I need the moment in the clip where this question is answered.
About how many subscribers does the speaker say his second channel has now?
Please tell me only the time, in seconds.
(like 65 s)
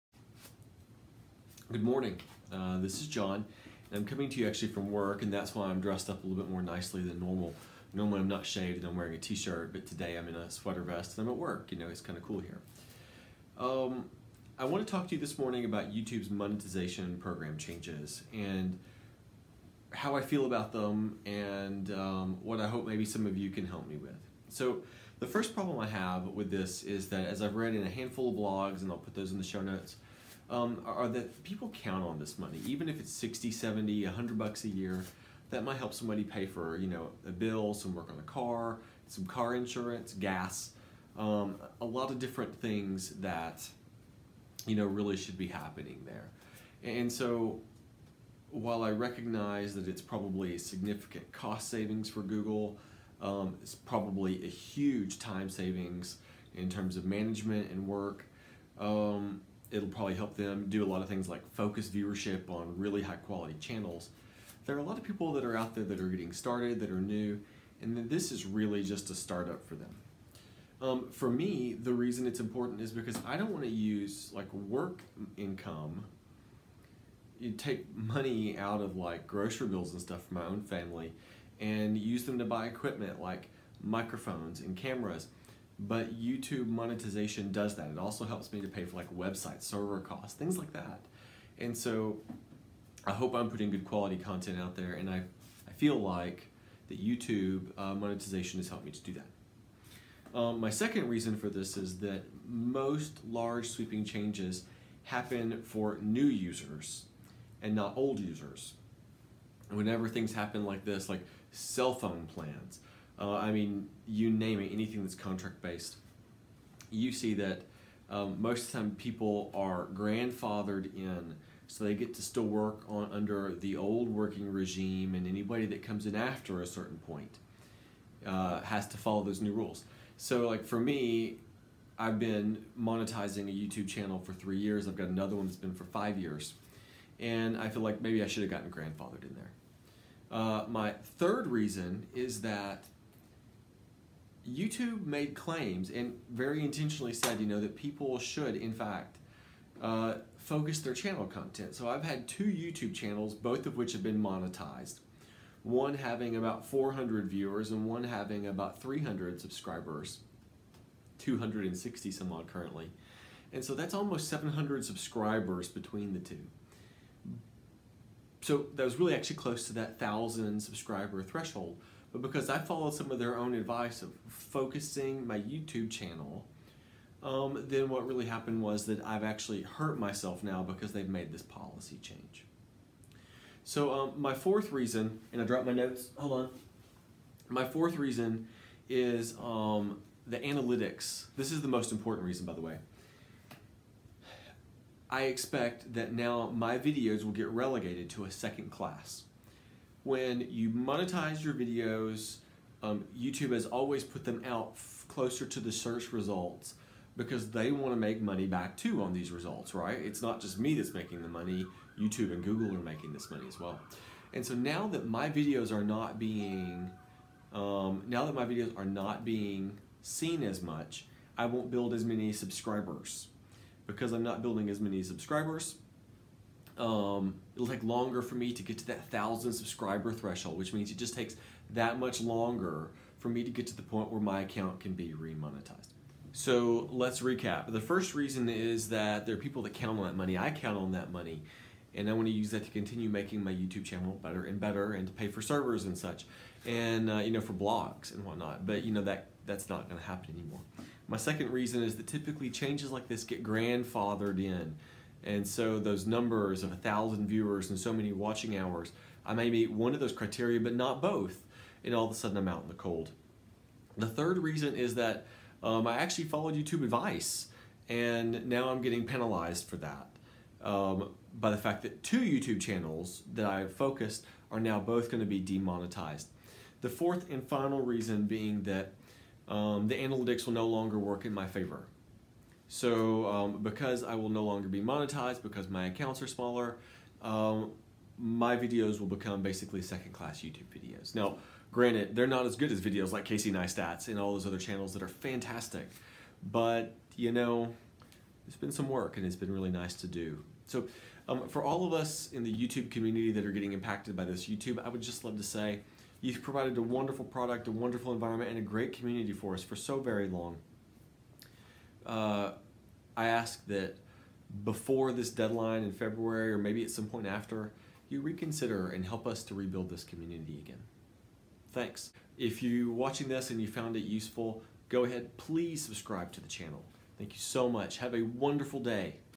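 161 s.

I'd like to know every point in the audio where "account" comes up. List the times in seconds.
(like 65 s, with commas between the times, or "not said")
234 s, 285 s.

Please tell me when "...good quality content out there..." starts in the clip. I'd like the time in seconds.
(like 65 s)
93 s.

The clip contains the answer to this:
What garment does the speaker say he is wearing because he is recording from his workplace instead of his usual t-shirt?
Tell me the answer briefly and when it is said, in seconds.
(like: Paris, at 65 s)
sweater vest, at 10 s.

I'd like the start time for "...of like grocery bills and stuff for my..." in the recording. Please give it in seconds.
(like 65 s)
78 s.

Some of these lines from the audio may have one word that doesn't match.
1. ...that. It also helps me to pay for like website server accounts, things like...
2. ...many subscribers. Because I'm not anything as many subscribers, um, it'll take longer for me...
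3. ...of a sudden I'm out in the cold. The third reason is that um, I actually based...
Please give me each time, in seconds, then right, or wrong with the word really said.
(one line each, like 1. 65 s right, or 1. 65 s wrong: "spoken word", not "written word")
1. 87 s wrong: "costs", not "accounts"
2. 222 s wrong: "building", not "anything"
3. 262 s wrong: "followed", not "based".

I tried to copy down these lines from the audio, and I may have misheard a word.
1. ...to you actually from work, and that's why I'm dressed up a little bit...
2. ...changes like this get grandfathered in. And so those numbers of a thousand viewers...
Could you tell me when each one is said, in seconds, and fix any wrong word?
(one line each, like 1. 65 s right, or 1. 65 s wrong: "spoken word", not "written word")
1. 4 s right
2. 252 s right.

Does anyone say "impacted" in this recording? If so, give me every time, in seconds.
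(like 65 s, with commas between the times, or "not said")
303 s.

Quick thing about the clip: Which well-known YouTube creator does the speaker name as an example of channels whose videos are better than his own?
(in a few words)
Casey Neistat.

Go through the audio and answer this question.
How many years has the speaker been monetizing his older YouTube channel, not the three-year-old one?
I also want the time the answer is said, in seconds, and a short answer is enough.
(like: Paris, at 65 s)
5 years, at 135 s.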